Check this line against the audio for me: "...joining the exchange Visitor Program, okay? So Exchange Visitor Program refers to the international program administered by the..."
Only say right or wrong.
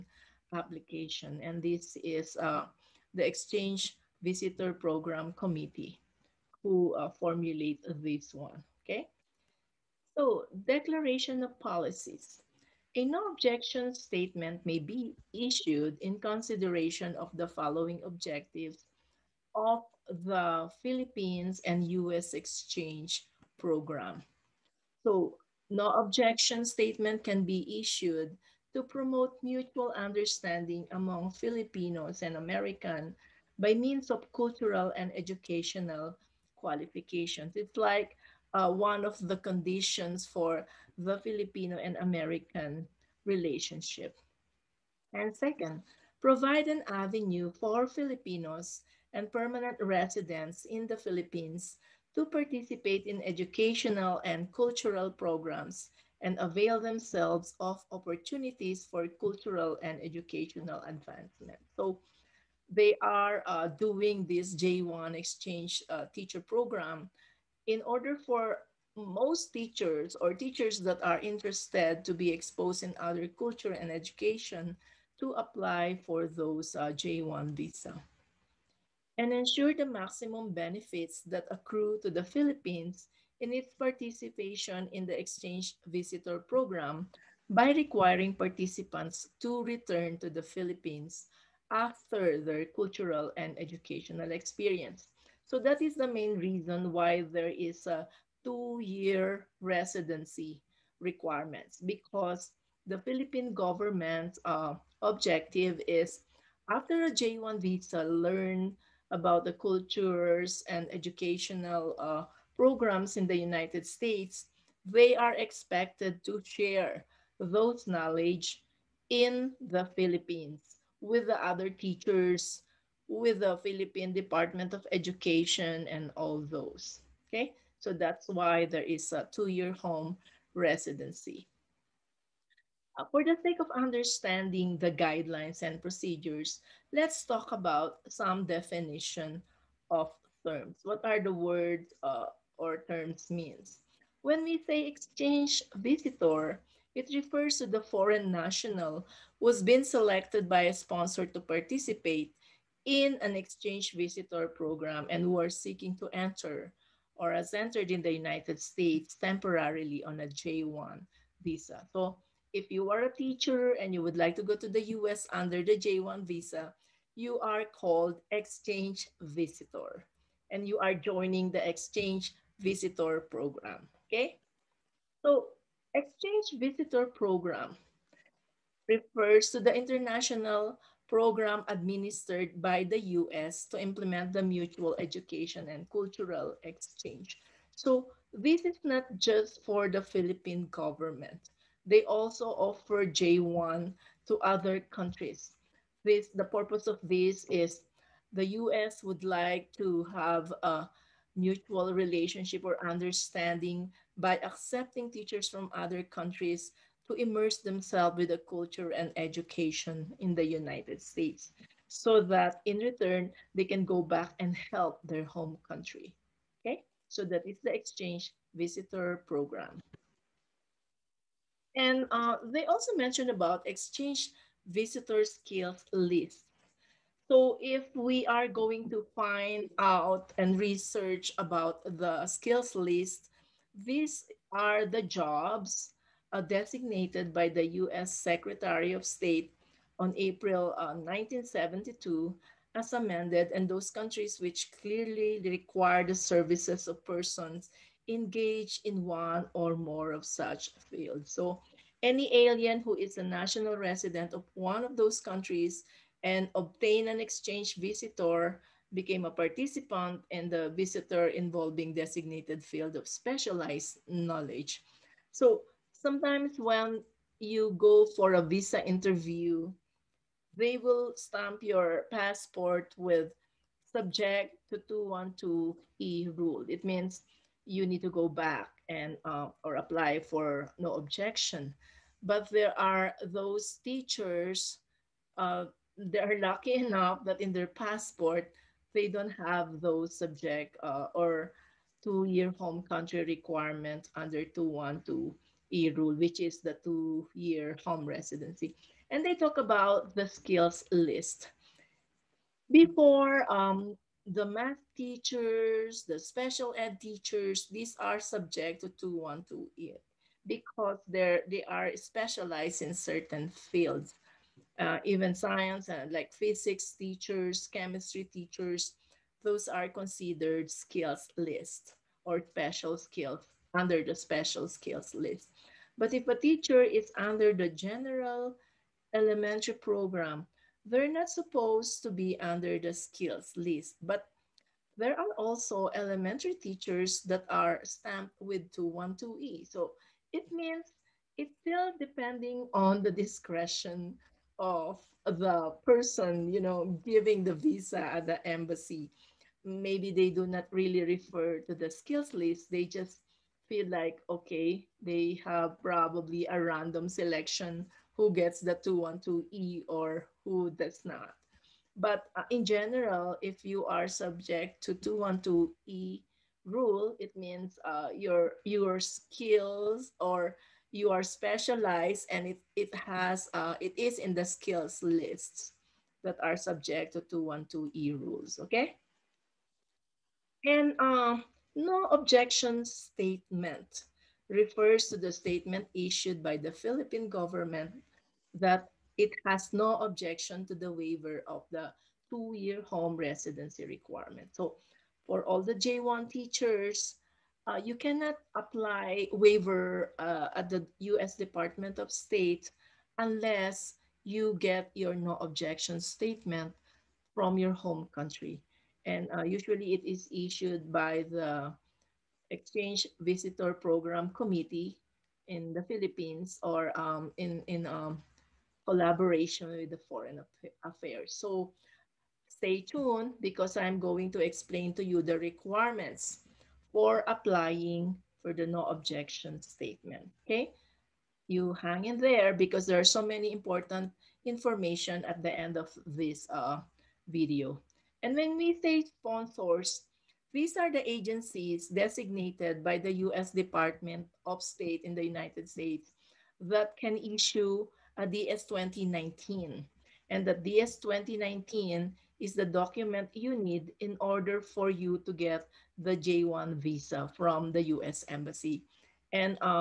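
right.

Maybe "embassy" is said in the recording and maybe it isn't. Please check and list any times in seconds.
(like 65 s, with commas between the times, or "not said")
348 s, 458 s.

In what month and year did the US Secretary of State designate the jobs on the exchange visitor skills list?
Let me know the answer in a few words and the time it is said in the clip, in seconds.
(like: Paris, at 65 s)
April 1972, at 240 s.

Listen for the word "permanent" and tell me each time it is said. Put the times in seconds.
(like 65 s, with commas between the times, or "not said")
49 s.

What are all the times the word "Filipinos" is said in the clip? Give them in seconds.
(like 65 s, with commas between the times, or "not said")
31 s, 41 s, 47 s.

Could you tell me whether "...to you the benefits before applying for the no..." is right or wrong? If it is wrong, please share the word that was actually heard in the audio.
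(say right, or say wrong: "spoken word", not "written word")
wrong: "requirements", not "benefits".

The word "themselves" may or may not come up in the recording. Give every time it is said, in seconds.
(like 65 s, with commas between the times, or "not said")
56 s, 207 s.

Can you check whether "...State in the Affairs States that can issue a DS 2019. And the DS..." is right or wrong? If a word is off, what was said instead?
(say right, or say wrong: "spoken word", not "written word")
wrong: "United", not "Affairs".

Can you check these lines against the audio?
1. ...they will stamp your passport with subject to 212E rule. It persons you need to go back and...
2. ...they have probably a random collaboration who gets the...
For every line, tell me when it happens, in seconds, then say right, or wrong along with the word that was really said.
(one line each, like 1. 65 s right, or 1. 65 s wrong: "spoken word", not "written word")
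1. 270 s wrong: "means", not "persons"
2. 355 s wrong: "selection", not "collaboration".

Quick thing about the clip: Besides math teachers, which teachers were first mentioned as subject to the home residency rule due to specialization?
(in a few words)
special ed teachers.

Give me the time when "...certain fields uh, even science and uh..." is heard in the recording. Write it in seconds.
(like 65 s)
312 s.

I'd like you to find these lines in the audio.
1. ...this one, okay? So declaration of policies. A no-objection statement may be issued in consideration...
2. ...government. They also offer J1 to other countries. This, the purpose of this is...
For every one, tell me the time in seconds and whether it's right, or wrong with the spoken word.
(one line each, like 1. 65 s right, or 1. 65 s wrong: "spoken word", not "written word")
1. 8 s right
2. 190 s right.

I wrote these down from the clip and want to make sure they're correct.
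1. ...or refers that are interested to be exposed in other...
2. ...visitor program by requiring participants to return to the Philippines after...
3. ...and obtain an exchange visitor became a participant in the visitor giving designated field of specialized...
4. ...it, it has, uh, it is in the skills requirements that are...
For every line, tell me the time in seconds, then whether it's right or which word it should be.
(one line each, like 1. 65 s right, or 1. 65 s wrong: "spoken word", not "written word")
1. 70 s wrong: "teachers", not "refers"
2. 85 s right
3. 256 s wrong: "involving", not "giving"
4. 372 s wrong: "lists", not "requirements".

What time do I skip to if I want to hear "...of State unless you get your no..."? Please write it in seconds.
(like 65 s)
401 s.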